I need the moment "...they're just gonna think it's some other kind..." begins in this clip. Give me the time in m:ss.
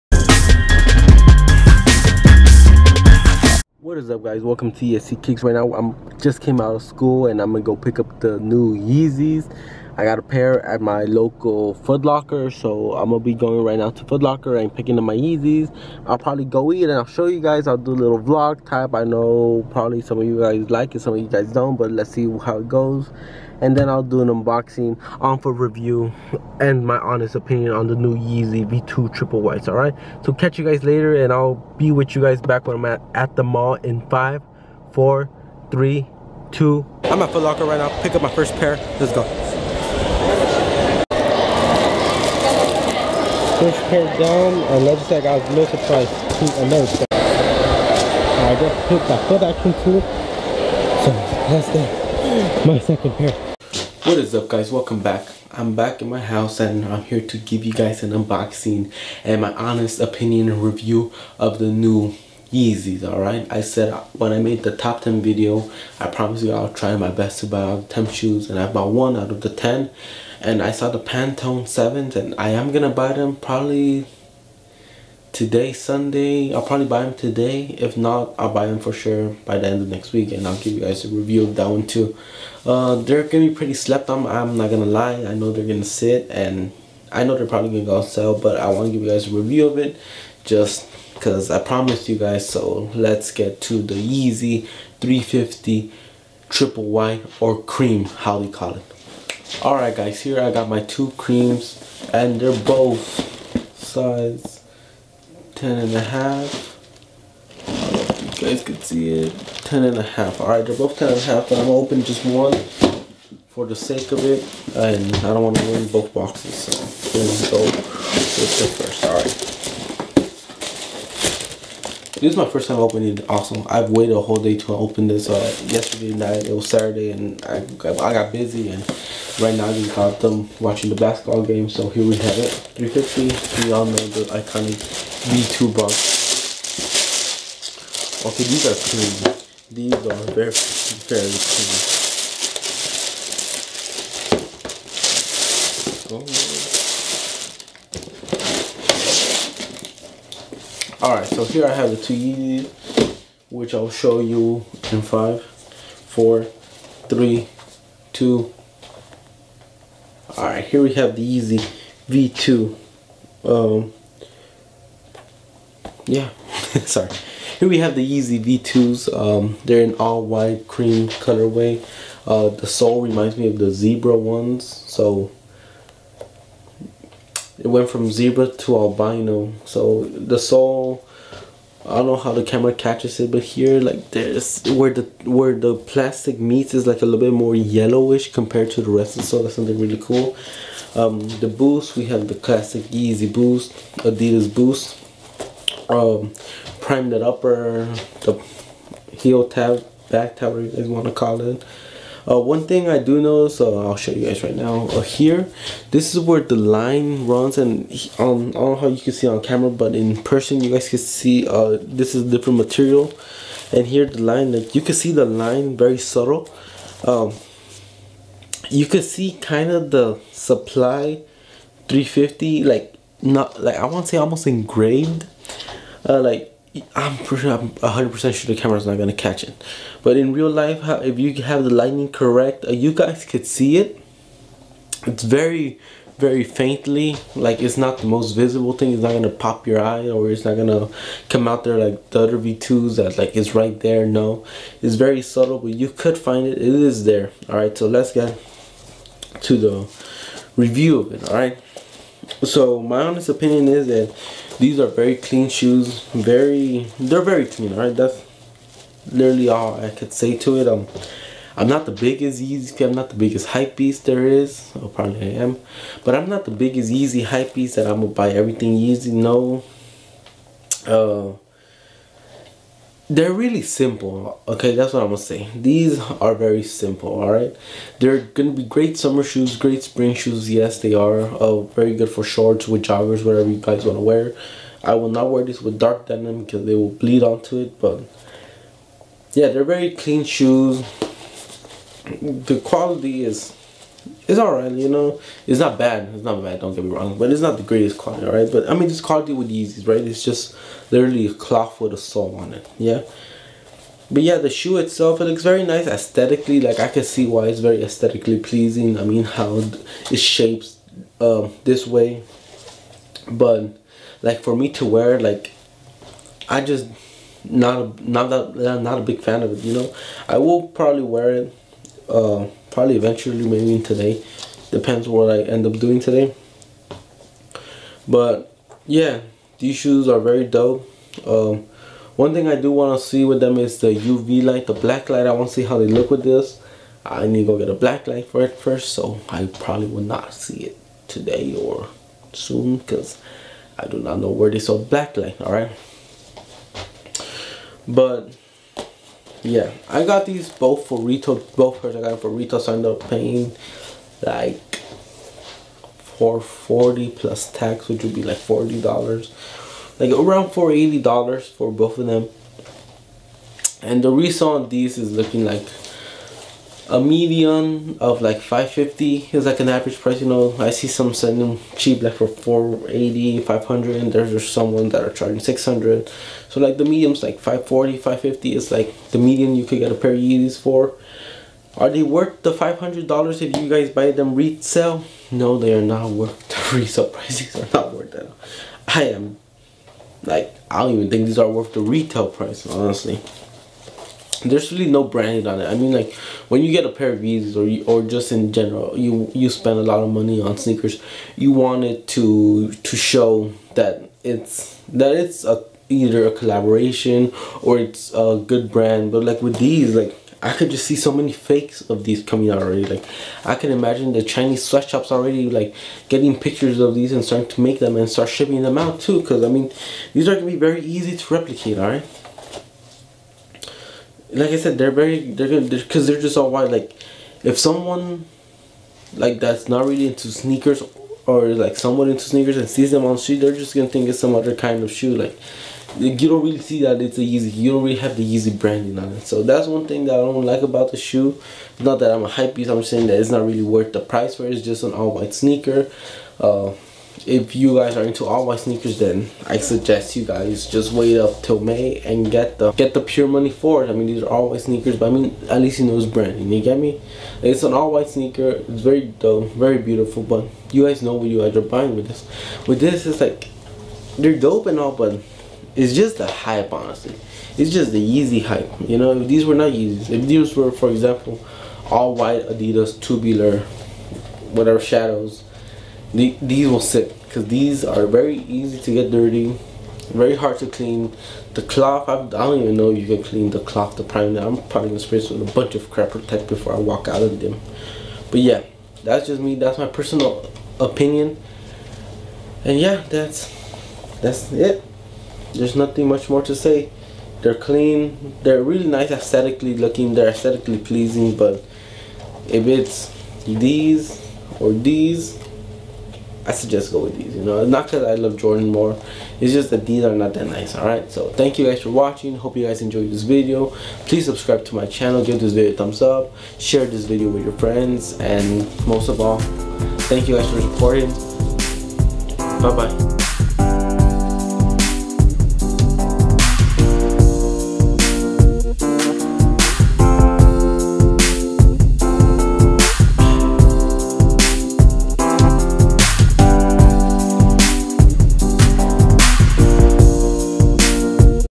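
7:13.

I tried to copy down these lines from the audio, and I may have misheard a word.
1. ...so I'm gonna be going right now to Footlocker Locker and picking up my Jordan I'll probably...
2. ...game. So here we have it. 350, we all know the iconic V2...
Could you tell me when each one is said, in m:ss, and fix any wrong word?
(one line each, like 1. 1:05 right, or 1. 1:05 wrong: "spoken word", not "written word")
1. 0:12 wrong: "Yeezys", not "Jordan"
2. 2:11 right.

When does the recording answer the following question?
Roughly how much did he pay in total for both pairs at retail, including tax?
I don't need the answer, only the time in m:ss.
6:00.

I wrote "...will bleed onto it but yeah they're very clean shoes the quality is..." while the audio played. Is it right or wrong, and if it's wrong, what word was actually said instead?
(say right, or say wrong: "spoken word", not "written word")
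right.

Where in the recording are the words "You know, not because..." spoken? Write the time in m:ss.
8:27.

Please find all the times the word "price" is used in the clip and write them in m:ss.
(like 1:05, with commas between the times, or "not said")
6:09, 6:27, 6:32, 7:23.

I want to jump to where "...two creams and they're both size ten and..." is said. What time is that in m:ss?
1:40.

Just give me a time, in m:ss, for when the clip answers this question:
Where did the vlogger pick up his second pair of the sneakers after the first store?
0:49.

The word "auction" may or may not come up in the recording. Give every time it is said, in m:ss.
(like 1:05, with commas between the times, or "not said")
not said.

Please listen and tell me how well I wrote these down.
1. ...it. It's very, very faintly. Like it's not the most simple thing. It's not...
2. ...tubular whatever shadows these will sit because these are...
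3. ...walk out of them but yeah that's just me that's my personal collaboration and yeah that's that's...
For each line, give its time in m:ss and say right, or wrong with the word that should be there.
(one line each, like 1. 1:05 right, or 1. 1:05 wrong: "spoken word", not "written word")
1. 3:53 wrong: "visible", not "simple"
2. 7:52 right
3. 8:06 wrong: "opinion", not "collaboration".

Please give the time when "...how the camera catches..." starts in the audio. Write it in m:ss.
3:02.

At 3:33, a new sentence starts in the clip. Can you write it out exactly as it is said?
And here the line, like you can see the line very subtle.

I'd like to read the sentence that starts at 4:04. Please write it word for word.
No, it's very subtle, but you could find it.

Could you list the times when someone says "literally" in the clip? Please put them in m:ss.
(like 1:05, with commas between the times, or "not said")
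4:19, 5:00.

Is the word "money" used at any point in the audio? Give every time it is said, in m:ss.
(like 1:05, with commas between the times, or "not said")
6:40, 7:33.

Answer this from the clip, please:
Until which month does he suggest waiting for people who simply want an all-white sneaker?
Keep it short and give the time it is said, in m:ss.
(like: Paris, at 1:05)
May, at 7:31.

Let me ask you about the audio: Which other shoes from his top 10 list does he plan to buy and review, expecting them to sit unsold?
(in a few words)
Pantone 7s.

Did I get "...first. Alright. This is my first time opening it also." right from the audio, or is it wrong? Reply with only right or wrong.
right.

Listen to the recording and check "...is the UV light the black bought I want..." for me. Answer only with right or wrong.
wrong.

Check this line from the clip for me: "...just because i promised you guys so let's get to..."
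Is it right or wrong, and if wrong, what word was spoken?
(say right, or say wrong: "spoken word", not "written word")
right.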